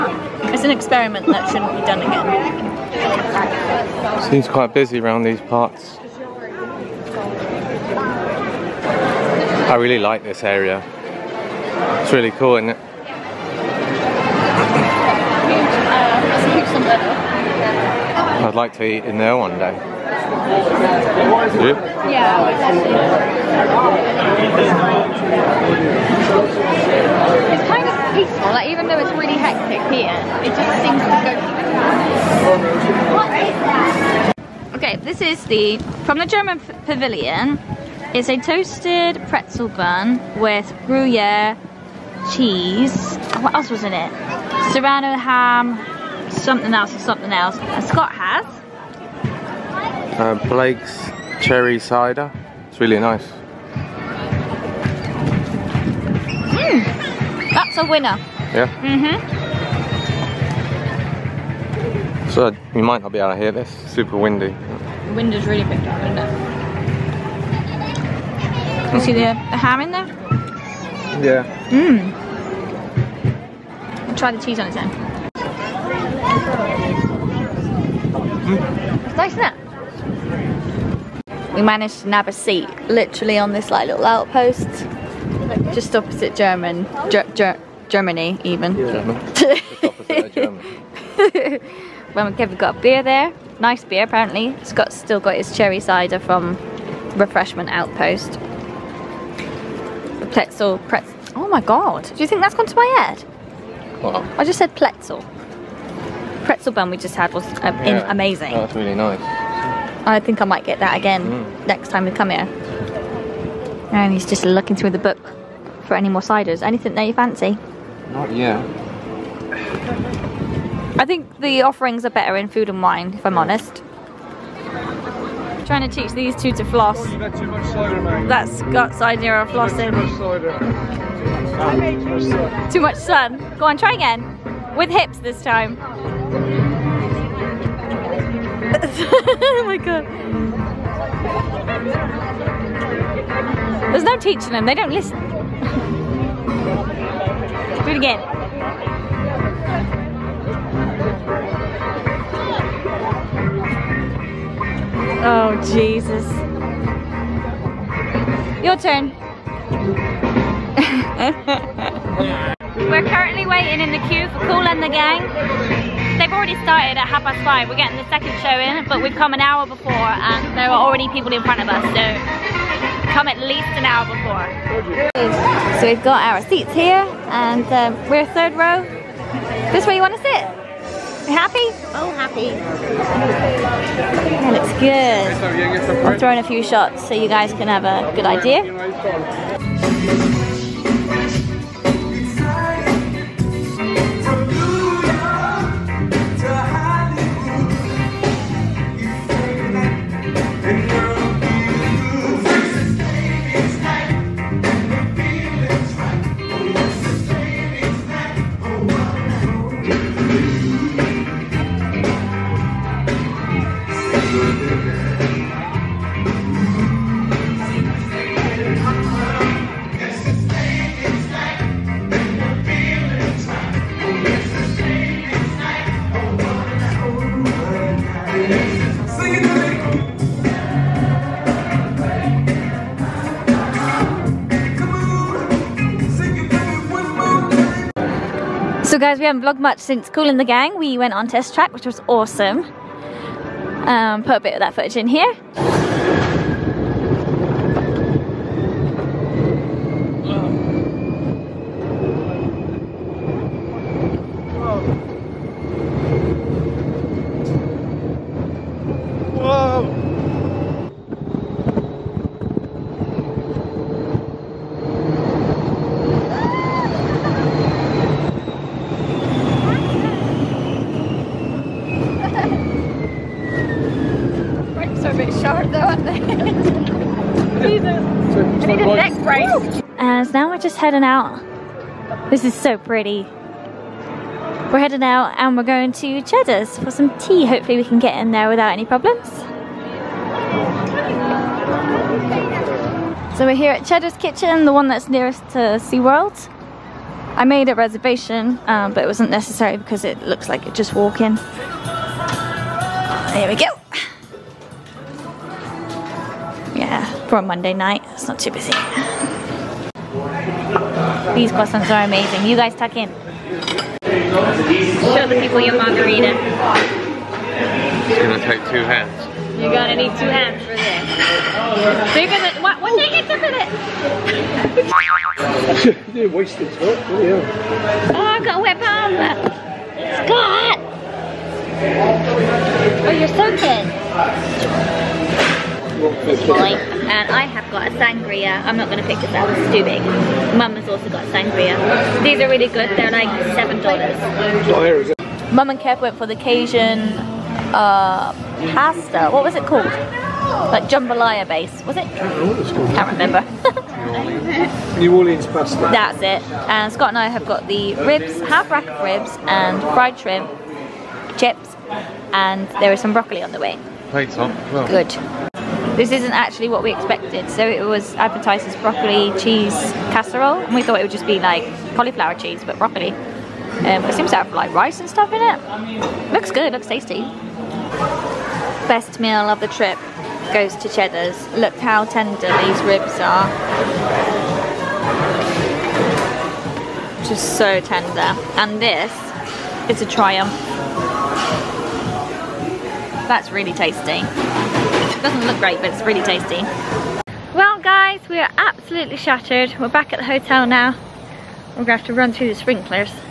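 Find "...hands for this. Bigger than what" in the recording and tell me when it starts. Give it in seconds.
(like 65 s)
320 s.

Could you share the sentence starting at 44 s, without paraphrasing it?
Serrano ham, something else and something else.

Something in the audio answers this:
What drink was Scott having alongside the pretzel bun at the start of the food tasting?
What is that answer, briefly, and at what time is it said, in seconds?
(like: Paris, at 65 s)
Blake's cherry cider, at 50 s.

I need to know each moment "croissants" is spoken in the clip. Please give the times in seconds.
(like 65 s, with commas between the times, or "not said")
311 s.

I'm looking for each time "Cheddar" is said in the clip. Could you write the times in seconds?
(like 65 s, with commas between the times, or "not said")
286 s, 293 s, 380 s.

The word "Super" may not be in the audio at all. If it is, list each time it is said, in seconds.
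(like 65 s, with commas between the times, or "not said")
63 s.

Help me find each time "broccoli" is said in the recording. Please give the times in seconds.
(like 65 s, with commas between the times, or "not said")
363 s, 368 s, 372 s.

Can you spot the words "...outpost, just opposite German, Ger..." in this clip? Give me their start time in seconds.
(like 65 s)
84 s.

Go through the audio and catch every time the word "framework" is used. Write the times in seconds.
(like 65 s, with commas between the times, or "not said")
not said.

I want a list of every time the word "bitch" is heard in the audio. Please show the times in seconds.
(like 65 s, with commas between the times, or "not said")
not said.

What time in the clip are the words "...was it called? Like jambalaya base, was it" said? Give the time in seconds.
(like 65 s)
349 s.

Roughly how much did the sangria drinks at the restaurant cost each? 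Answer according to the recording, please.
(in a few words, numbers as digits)
$7.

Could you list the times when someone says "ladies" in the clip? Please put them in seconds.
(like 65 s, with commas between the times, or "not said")
not said.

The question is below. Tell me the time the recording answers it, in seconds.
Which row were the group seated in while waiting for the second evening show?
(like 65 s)
178 s.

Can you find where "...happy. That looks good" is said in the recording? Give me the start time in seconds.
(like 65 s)
182 s.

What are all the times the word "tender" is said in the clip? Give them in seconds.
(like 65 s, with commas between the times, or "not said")
382 s, 387 s.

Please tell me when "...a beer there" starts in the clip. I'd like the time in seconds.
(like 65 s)
92 s.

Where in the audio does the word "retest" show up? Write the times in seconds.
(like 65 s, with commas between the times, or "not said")
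not said.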